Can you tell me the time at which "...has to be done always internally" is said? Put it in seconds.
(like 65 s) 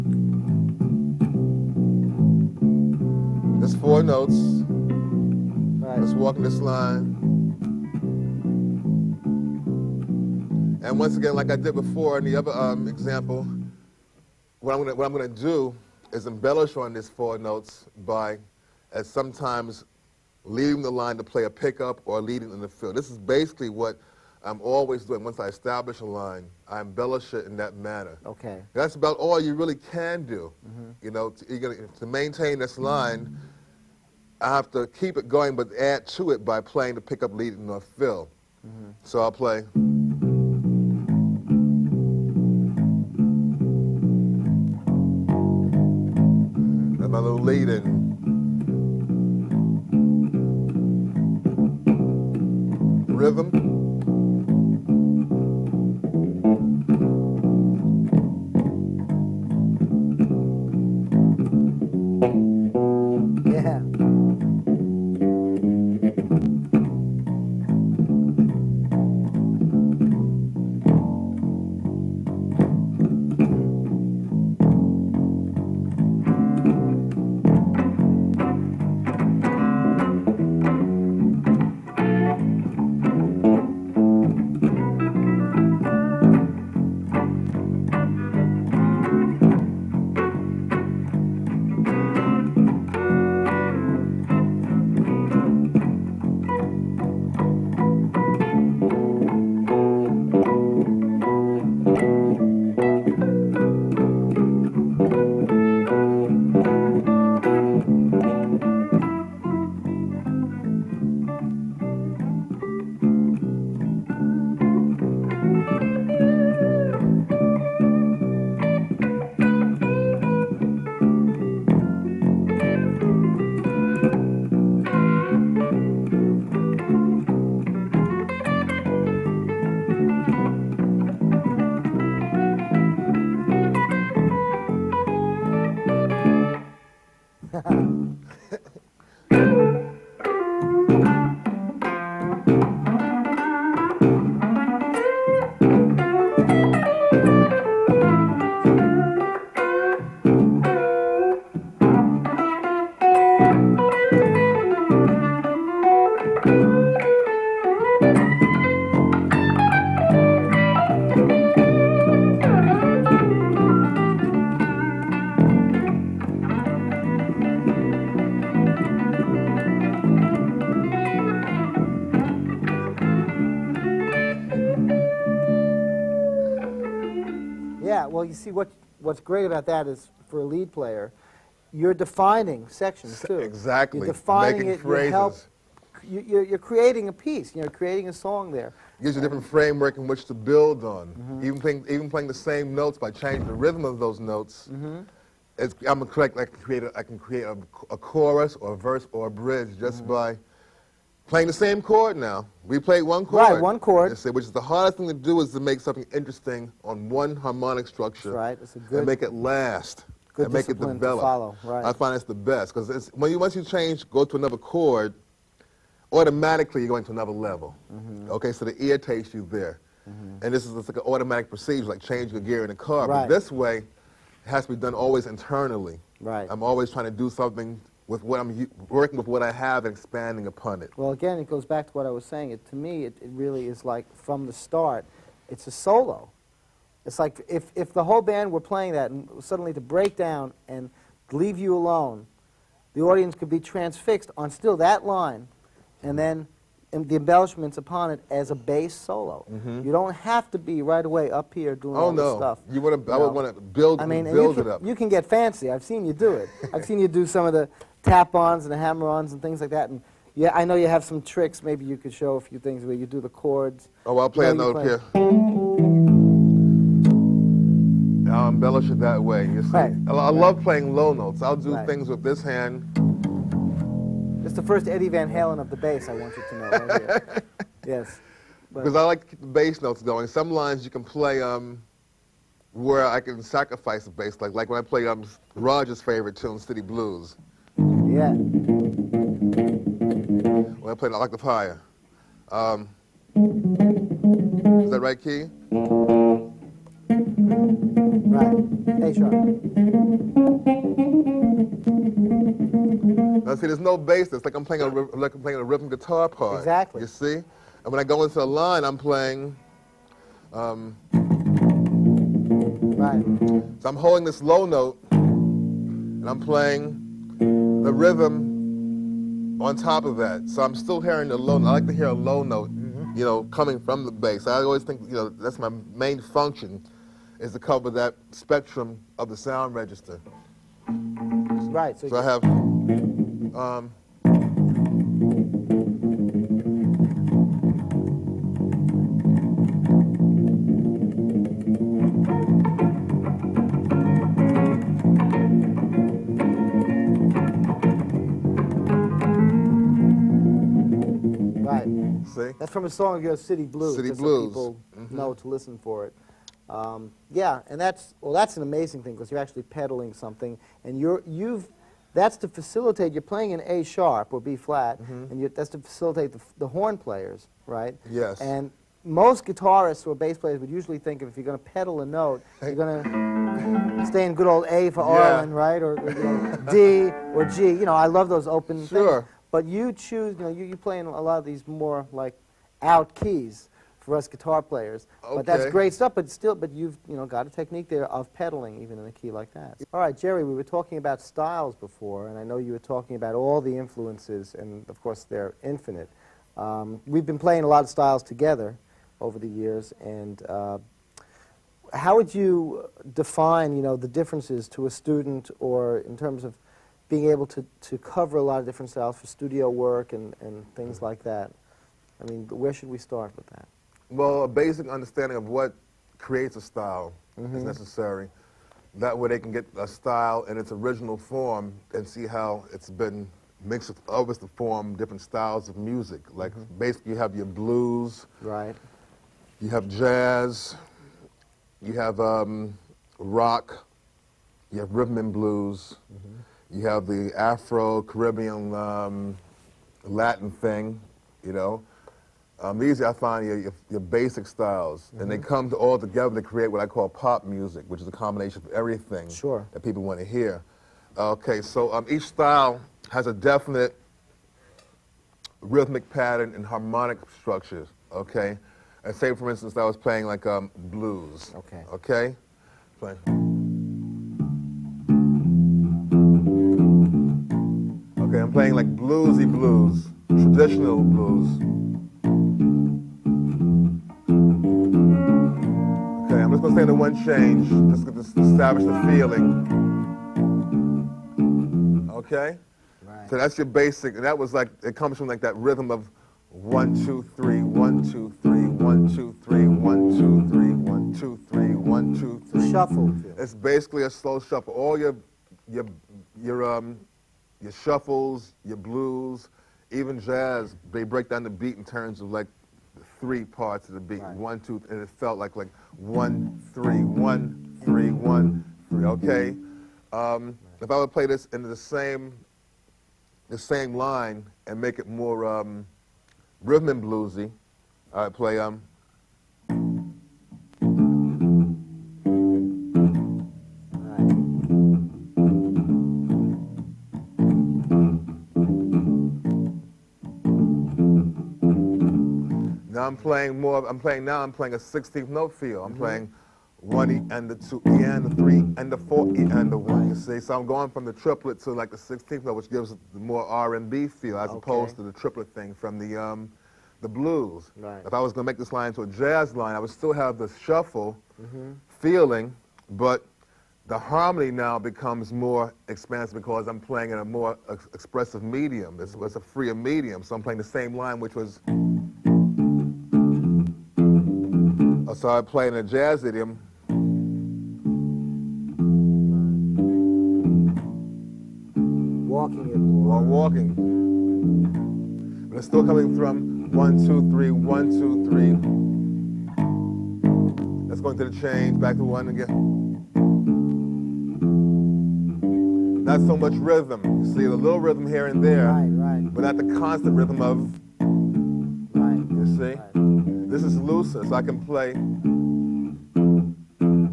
224 s.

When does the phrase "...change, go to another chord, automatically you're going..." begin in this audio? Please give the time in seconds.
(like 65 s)
213 s.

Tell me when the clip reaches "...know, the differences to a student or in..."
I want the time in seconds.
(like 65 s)
403 s.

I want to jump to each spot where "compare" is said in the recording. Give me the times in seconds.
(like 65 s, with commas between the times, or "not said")
not said.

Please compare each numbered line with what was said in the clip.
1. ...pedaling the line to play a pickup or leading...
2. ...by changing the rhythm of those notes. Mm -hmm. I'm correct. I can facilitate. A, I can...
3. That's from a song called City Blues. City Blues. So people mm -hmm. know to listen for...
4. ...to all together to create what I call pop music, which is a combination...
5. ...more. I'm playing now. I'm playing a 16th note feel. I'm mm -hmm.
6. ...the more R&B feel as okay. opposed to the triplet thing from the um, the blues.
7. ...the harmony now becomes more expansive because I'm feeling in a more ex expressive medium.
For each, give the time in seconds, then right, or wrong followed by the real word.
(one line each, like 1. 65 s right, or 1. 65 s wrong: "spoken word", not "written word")
1. 20 s wrong: "leaving", not "pedaling"
2. 193 s wrong: "create", not "facilitate"
3. 352 s right
4. 445 s right
5. 533 s right
6. 543 s right
7. 553 s wrong: "playing", not "feeling".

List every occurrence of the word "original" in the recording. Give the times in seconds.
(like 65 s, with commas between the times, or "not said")
420 s.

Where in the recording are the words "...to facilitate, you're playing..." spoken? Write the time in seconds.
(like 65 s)
362 s.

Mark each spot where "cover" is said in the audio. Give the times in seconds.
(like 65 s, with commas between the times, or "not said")
327 s, 407 s.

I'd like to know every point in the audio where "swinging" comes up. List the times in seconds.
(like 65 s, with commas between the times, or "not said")
not said.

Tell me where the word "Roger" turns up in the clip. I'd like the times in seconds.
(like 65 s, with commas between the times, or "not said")
285 s.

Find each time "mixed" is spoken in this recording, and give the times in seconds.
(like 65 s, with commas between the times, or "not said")
423 s.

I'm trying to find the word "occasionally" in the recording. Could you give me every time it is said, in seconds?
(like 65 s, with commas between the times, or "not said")
not said.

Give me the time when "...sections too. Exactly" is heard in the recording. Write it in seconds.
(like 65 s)
182 s.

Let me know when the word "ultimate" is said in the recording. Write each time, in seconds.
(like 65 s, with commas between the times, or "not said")
not said.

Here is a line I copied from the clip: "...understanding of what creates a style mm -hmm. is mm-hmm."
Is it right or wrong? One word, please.
right.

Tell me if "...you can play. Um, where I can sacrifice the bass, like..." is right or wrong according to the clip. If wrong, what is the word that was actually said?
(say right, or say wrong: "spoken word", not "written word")
right.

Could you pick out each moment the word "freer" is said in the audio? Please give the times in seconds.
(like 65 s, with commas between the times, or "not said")
559 s.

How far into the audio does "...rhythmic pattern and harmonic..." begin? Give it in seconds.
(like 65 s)
455 s.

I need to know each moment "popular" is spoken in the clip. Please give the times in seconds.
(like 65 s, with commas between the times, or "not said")
not said.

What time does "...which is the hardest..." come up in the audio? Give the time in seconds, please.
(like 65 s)
204 s.